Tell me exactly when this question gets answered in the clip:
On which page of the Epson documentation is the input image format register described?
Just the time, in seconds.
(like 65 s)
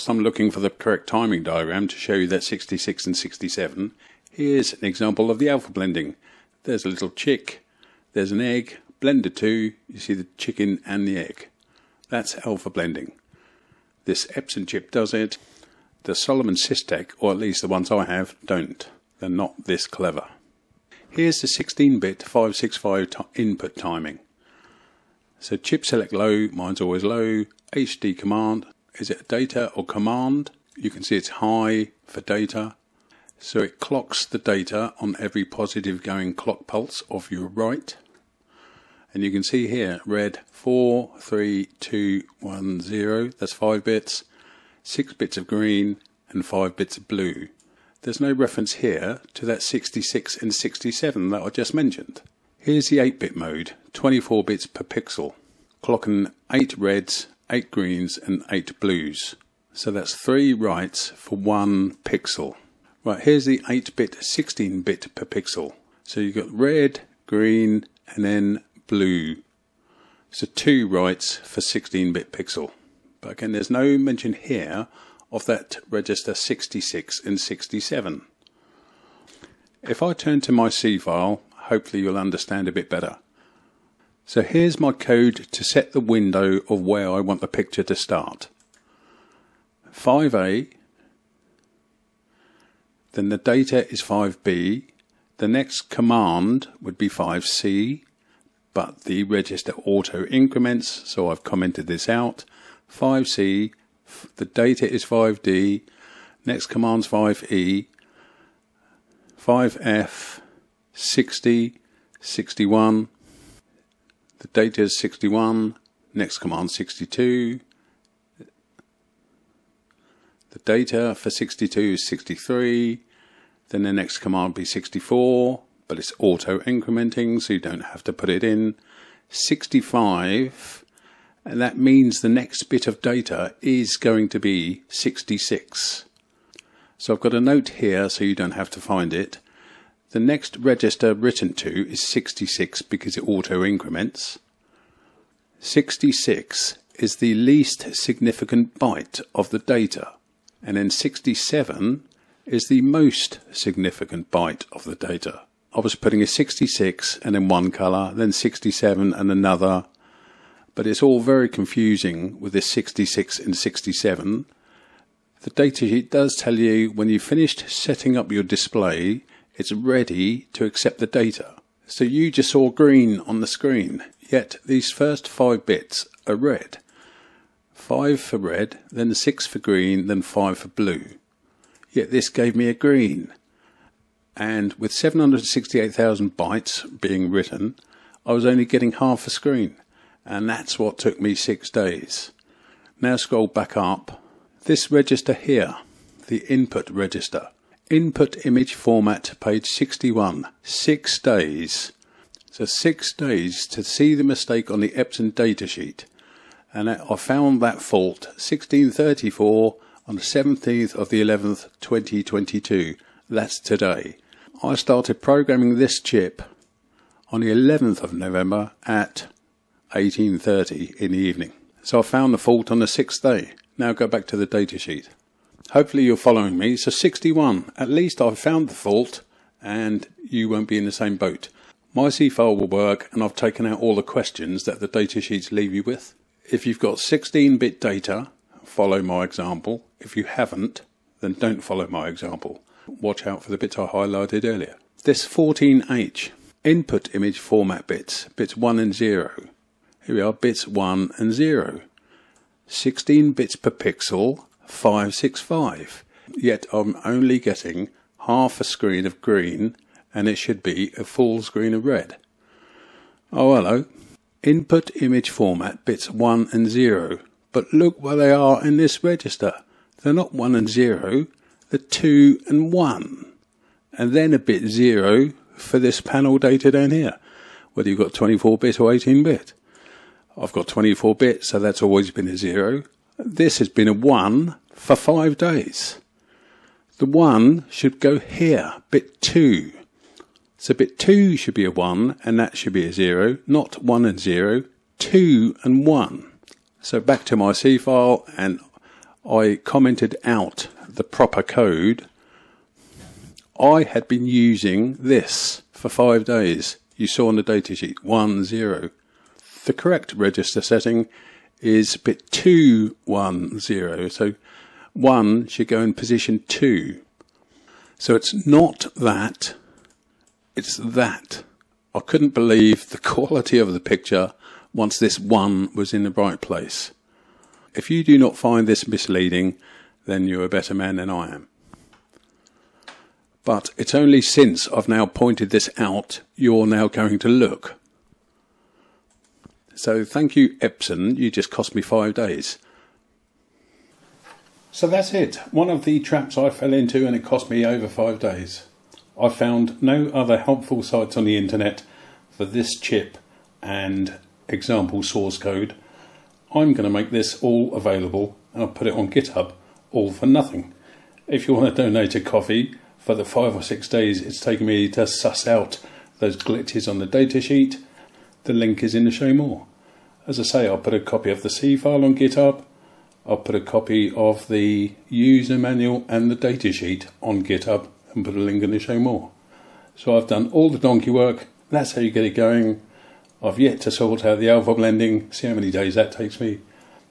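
199 s.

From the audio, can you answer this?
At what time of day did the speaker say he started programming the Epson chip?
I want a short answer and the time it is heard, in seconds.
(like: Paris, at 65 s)
18:30, at 219 s.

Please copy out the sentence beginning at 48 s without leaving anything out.
There's no reference here to that 66 and 67 that I just mentioned.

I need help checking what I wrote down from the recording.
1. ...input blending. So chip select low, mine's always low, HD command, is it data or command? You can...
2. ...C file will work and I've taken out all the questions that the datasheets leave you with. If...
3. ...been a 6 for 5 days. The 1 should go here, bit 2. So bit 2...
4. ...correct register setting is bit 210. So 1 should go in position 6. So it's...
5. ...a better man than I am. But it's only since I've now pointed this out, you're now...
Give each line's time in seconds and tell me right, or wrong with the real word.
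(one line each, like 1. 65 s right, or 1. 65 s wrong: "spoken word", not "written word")
1. 23 s wrong: "timing", not "blending"
2. 232 s right
3. 283 s wrong: "1", not "6"
4. 309 s wrong: "2", not "6"
5. 330 s right.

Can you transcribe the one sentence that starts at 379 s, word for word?
So I've done all the donkey work.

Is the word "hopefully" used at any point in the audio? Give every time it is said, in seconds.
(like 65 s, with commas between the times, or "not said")
81 s, 225 s.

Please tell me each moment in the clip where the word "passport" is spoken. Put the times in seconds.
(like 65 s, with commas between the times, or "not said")
not said.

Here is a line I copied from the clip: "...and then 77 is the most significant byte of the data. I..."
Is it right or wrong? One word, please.
wrong.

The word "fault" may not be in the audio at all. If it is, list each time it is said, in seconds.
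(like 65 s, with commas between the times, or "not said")
207 s, 222 s, 228 s.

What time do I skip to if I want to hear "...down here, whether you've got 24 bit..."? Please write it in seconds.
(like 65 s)
276 s.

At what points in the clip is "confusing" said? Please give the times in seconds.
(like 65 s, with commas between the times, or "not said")
161 s.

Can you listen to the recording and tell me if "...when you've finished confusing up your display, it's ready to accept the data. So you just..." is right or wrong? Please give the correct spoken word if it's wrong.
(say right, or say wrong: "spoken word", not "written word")
wrong: "setting", not "confusing".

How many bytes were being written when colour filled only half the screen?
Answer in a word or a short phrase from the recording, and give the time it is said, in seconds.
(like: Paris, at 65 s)
768,000, at 184 s.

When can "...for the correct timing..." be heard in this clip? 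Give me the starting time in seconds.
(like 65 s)
0 s.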